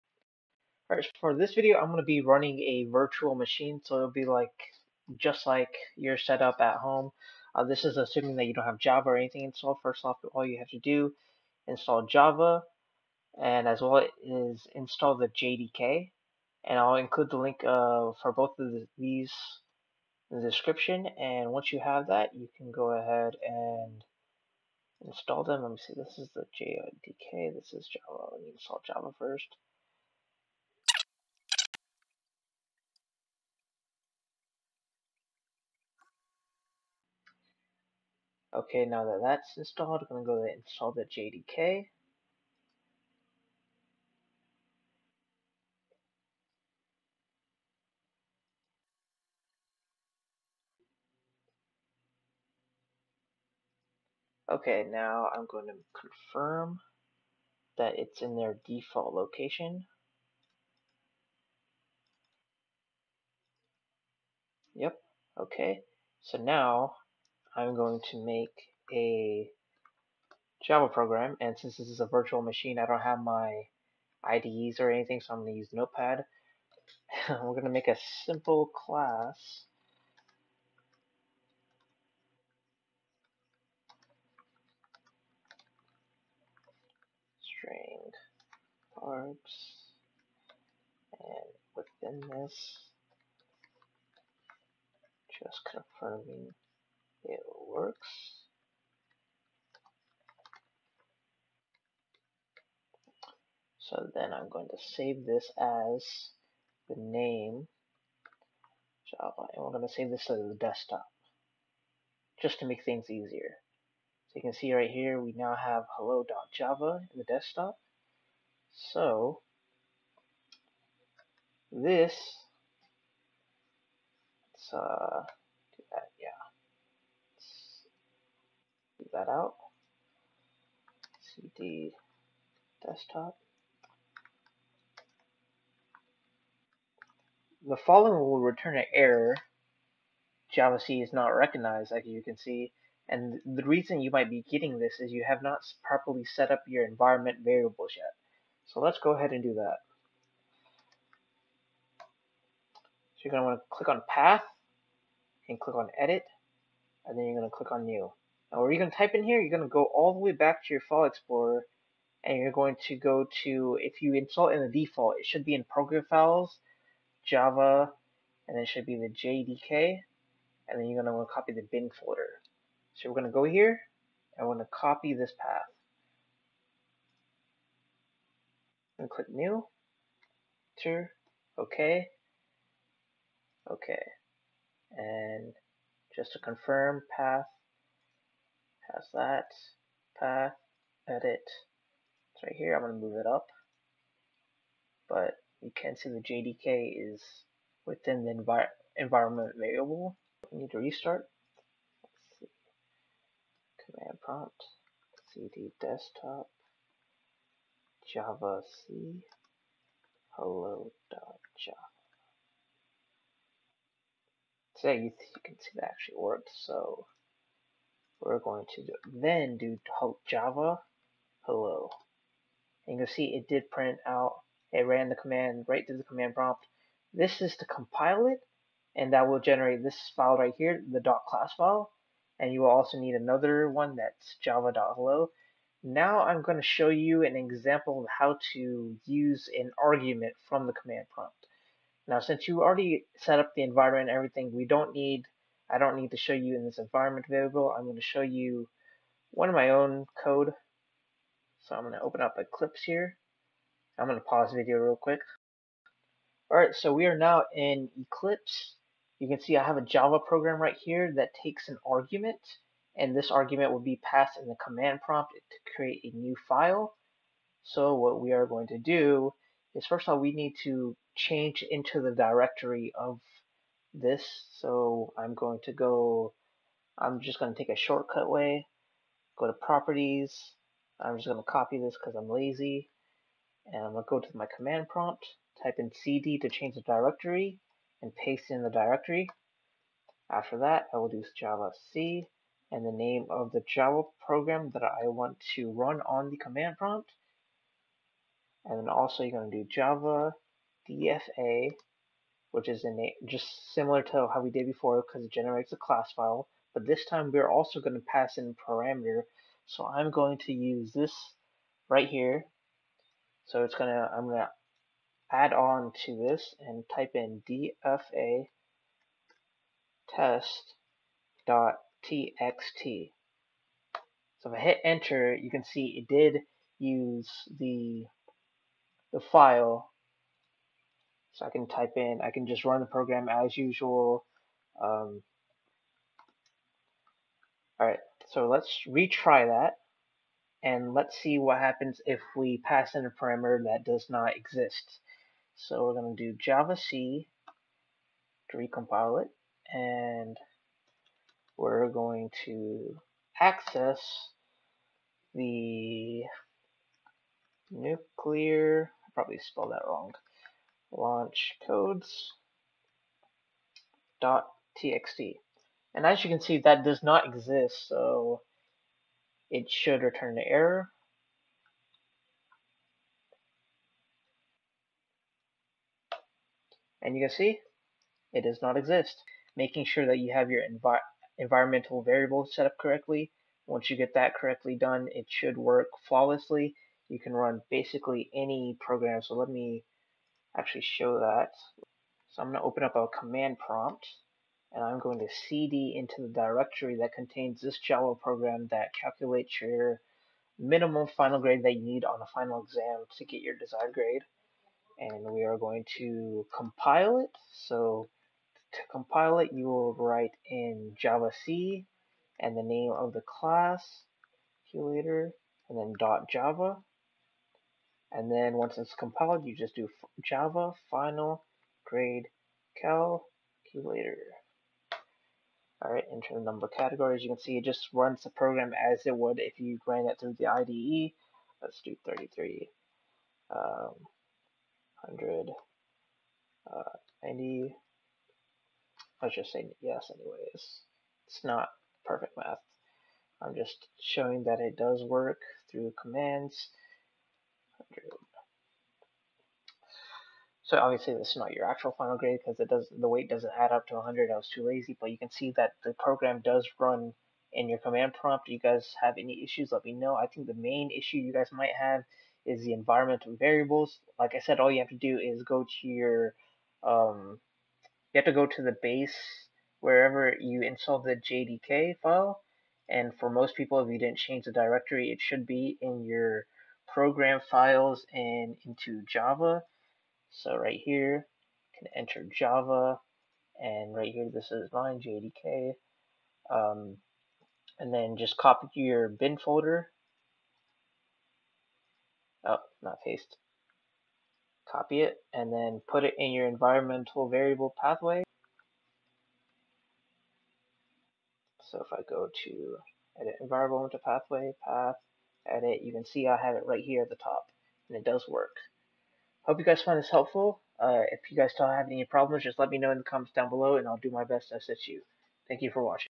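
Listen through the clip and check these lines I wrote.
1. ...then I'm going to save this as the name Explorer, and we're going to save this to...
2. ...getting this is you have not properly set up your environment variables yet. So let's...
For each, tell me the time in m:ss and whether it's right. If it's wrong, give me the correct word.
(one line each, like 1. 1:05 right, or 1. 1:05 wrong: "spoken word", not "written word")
1. 1:44 wrong: "Java", not "Explorer"
2. 2:24 right.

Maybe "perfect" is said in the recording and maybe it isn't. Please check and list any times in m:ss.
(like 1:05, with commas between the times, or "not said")
7:22.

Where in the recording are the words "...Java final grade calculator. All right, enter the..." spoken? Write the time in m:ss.
7:00.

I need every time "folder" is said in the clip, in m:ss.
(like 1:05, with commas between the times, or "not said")
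2:51, 8:09.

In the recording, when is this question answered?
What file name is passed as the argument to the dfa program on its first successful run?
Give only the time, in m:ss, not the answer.
5:20.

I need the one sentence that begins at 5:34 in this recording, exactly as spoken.
Um, all right, so let's retry that and let's see what happens if we pass in a parameter that does not exist.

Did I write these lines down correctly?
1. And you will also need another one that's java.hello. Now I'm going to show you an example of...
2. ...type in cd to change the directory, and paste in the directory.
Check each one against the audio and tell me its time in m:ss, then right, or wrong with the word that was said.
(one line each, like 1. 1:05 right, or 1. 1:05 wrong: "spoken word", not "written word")
1. 3:52 right
2. 4:45 right.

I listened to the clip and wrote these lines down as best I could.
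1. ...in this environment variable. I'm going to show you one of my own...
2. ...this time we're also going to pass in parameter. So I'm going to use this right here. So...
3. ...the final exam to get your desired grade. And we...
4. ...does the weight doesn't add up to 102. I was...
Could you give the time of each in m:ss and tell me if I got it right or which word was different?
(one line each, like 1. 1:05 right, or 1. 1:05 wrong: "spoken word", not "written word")
1. 4:06 right
2. 5:06 right
3. 6:42 right
4. 7:32 wrong: "100", not "102".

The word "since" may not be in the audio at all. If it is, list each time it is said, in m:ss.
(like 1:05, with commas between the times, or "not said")
1:11, 4:02.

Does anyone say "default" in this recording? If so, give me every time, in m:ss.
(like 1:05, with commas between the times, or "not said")
0:58, 2:44.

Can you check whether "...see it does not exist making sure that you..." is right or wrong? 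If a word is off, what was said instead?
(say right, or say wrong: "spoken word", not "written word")
right.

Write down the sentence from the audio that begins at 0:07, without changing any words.
Uh, this is assuming that you don't have Java or anything installed.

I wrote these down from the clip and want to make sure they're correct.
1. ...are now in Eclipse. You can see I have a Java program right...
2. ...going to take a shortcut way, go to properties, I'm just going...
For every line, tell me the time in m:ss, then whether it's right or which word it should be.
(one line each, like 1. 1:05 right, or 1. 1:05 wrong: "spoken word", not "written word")
1. 4:17 right
2. 4:37 right.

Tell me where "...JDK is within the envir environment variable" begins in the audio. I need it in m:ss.
3:16.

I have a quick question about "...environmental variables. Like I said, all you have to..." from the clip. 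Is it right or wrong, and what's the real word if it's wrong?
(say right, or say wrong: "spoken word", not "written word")
right.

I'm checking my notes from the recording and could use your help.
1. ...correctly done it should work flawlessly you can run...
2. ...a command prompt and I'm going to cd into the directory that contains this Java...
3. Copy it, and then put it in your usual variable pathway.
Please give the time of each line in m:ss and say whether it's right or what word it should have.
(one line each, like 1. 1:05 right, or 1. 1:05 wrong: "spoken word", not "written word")
1. 6:24 right
2. 6:32 right
3. 8:14 wrong: "environmental", not "usual".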